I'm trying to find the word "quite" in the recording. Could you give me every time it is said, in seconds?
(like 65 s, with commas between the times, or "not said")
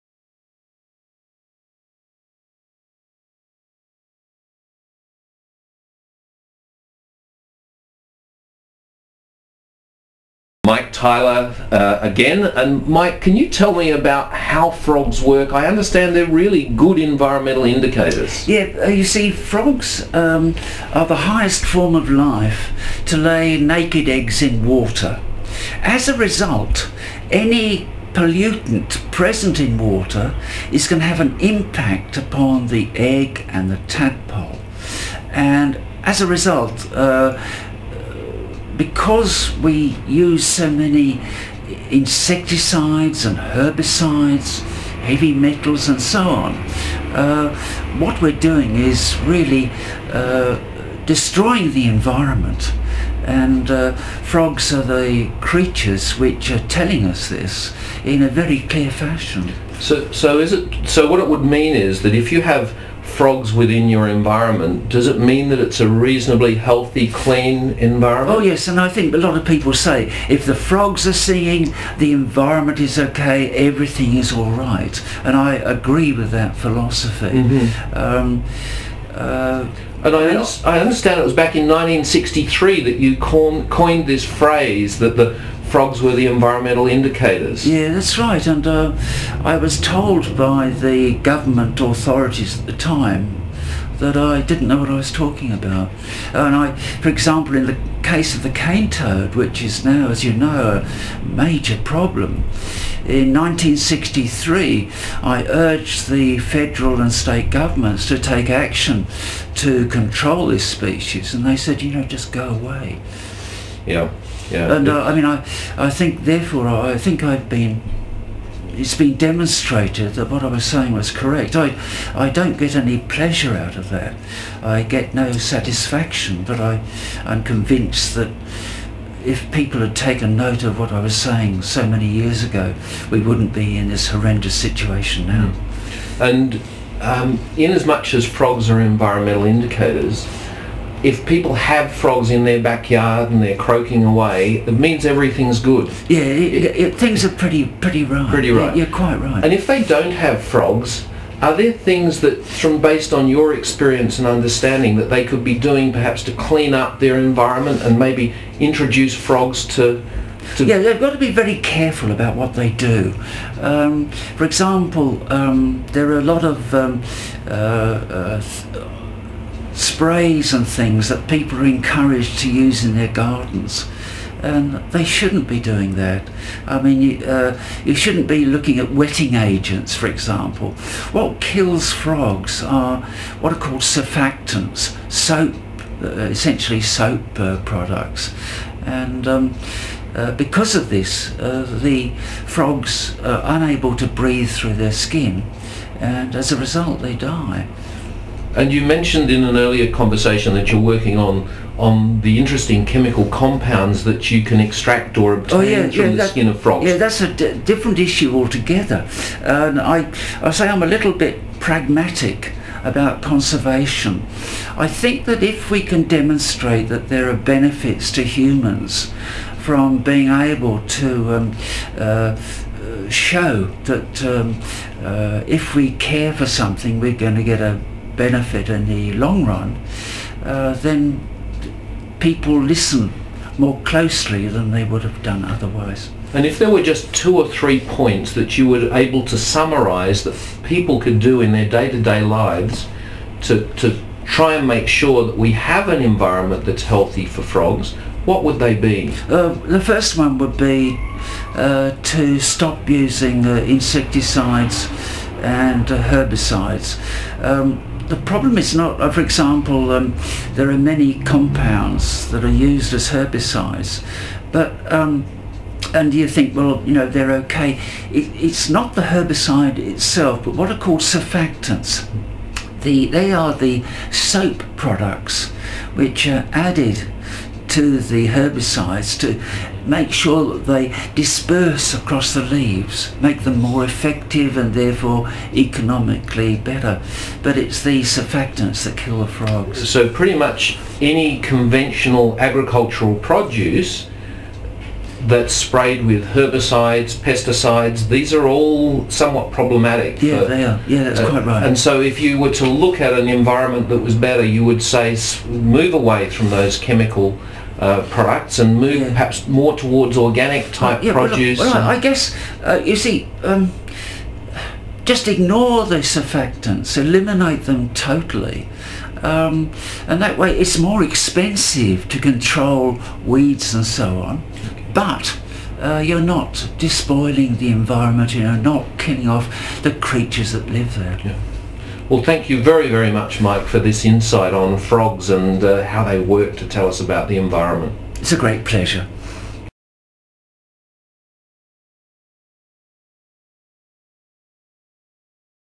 148 s, 301 s.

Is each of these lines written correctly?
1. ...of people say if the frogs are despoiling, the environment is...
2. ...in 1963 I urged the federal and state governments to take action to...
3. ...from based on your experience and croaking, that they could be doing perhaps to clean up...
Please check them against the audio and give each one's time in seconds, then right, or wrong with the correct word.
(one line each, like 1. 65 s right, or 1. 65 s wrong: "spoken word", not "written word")
1. 69 s wrong: "singing", not "despoiling"
2. 103 s right
3. 152 s wrong: "understanding", not "croaking".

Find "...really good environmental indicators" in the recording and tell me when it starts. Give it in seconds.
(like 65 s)
16 s.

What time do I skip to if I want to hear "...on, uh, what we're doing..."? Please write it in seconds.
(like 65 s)
46 s.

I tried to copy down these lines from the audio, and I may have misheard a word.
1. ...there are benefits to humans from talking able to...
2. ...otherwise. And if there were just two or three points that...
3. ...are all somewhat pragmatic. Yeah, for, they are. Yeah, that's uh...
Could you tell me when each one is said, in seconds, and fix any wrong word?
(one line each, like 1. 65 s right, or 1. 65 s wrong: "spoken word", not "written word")
1. 217 s wrong: "being", not "talking"
2. 235 s right
3. 298 s wrong: "problematic", not "pragmatic".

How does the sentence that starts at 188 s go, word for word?
And um, uh, because of this, uh, the frogs are unable to breathe through their skin, and as a result, they die.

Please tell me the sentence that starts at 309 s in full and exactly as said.
perhaps more towards organic type yeah, produce.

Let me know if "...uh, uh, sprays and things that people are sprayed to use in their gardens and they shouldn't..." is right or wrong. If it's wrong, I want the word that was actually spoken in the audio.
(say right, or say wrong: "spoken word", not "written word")
wrong: "encouraged", not "sprayed".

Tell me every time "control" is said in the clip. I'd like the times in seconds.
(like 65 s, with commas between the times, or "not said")
109 s, 322 s.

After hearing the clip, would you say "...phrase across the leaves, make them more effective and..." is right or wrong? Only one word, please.
wrong.